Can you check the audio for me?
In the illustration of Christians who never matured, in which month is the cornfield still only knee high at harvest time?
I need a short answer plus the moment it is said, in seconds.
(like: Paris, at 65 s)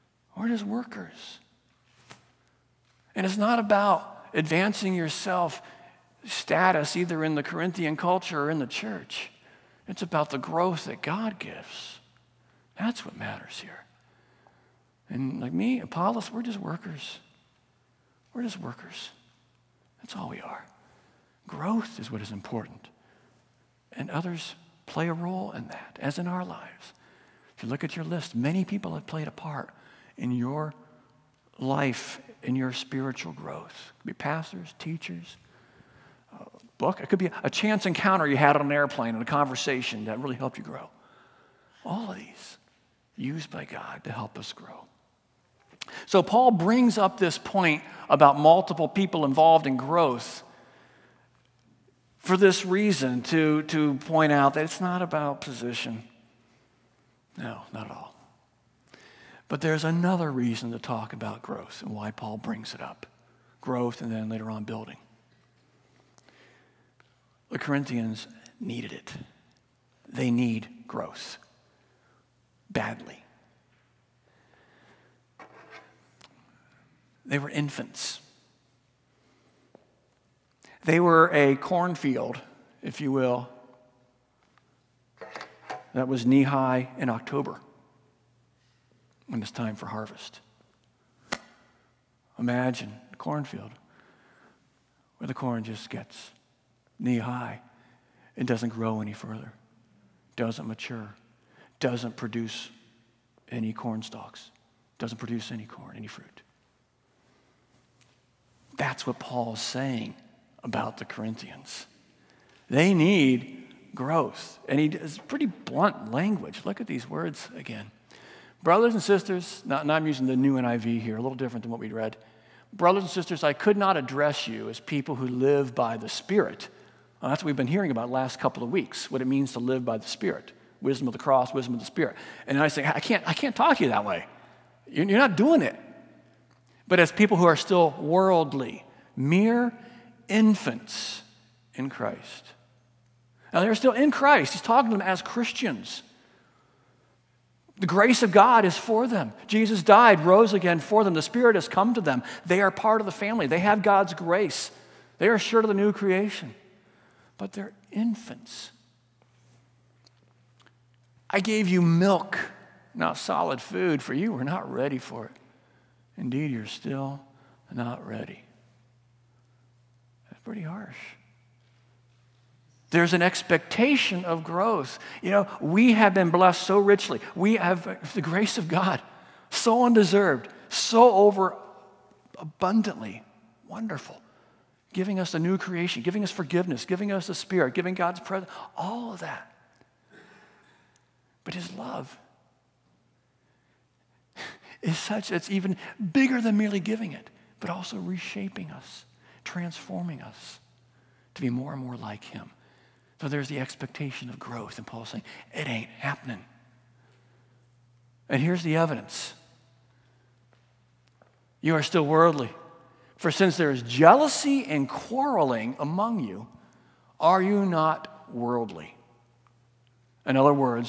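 October, at 87 s.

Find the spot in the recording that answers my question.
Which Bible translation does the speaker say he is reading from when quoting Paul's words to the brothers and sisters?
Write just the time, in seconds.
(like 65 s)
120 s.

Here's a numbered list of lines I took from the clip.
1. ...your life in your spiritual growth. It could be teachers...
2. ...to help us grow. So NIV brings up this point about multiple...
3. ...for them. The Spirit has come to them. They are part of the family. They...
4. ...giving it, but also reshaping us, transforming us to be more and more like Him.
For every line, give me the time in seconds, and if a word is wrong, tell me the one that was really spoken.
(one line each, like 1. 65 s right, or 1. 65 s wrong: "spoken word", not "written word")
1. 30 s wrong: "pastors", not "teachers"
2. 44 s wrong: "Paul", not "NIV"
3. 150 s right
4. 196 s right.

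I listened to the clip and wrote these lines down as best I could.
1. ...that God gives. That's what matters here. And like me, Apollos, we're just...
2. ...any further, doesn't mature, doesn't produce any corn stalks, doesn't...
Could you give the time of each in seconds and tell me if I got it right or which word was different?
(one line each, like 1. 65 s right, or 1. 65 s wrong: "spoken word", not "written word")
1. 10 s right
2. 99 s right.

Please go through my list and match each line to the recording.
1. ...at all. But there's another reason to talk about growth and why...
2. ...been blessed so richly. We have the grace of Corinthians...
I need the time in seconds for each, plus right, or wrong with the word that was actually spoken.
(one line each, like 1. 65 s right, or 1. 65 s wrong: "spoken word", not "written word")
1. 57 s right
2. 176 s wrong: "God", not "Corinthians".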